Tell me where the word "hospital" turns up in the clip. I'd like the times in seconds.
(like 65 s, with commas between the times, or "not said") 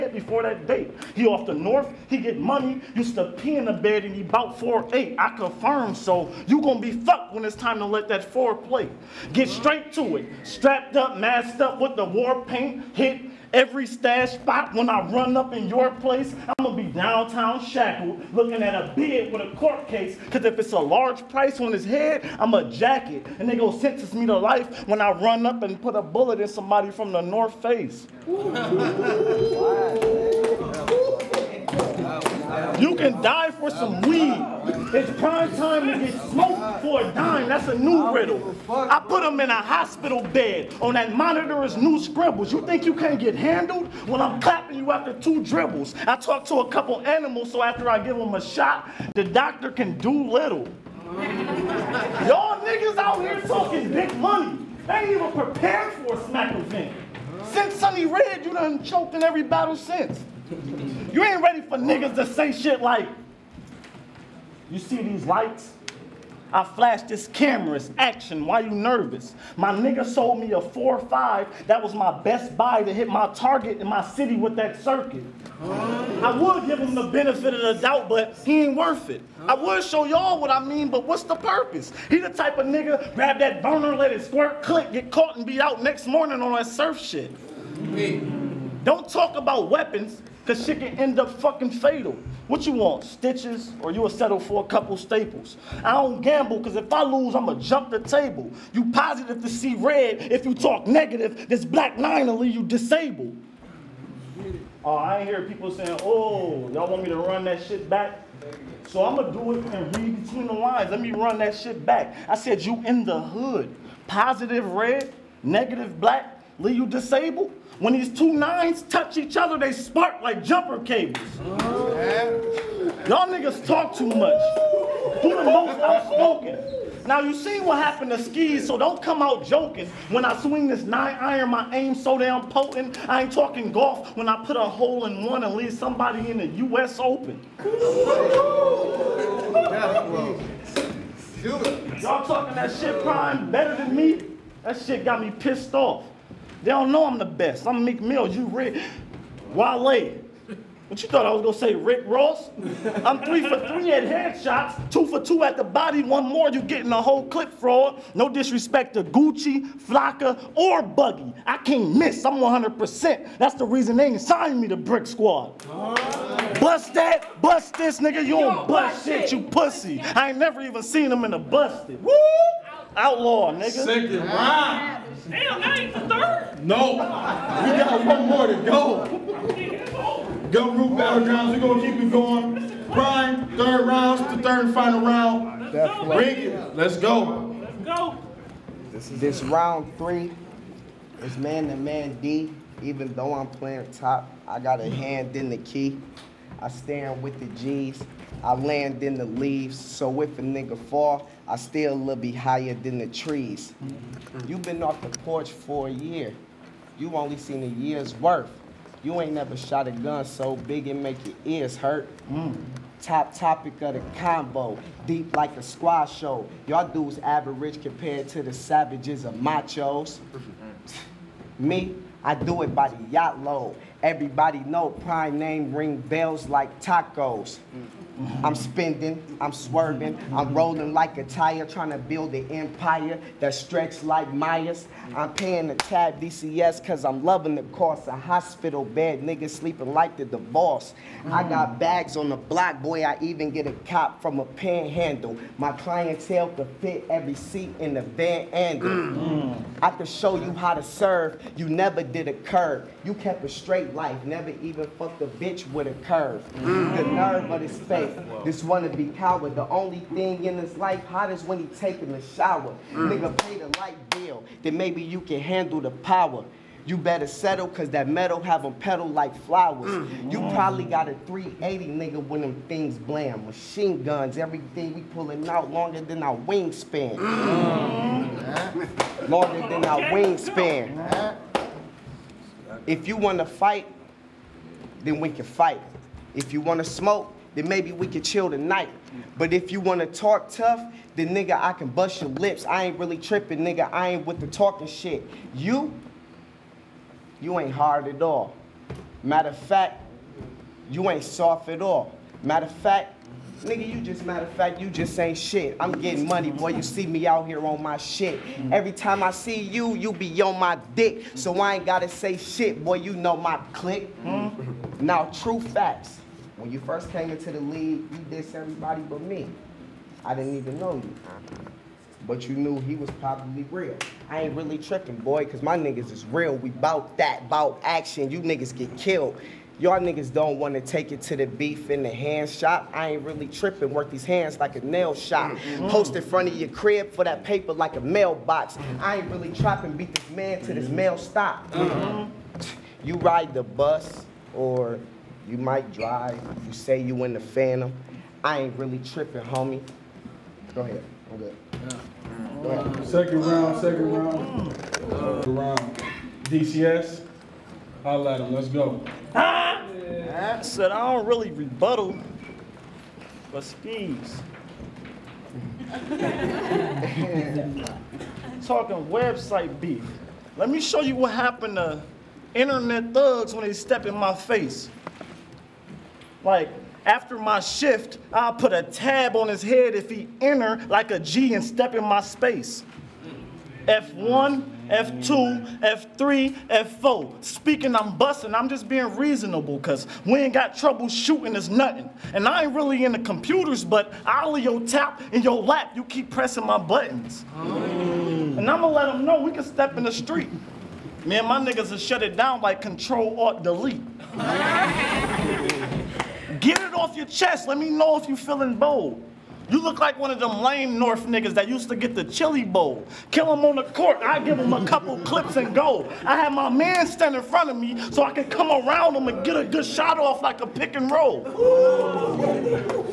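39 s, 238 s.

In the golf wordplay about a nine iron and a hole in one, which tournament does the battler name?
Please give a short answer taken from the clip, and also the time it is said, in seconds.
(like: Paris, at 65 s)
U.S. Open, at 136 s.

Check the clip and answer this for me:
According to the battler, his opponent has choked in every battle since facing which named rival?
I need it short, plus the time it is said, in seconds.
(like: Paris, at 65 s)
Sunny Red, at 57 s.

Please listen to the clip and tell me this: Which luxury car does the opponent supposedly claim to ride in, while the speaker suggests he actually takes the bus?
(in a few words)
Phantom.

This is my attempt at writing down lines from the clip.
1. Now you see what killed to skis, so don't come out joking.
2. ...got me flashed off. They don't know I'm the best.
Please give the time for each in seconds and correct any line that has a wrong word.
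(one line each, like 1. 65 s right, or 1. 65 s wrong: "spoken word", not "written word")
1. 127 s wrong: "happened", not "killed"
2. 145 s wrong: "pissed", not "flashed".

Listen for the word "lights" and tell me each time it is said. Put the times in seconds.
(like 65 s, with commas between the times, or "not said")
65 s, 263 s.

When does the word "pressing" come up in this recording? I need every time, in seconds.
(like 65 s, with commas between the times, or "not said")
396 s.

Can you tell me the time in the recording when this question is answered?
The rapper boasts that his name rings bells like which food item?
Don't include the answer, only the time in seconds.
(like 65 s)
226 s.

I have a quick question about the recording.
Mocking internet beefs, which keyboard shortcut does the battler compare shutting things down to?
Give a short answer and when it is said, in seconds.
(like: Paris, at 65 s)
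Control Alt Delete, at 402 s.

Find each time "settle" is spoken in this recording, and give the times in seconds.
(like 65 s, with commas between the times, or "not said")
94 s, 267 s.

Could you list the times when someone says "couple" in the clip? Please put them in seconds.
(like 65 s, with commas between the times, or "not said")
46 s, 94 s, 414 s.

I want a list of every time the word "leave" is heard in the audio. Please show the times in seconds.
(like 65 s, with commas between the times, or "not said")
102 s, 116 s, 135 s, 199 s.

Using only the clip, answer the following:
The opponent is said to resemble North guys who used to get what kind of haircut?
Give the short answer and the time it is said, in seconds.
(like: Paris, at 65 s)
Chili bowl, at 412 s.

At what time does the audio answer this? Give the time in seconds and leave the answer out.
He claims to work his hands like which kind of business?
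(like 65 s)
334 s.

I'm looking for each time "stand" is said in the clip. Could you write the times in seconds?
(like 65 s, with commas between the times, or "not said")
196 s, 417 s.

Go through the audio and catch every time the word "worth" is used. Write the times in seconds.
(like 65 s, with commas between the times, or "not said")
78 s, 208 s.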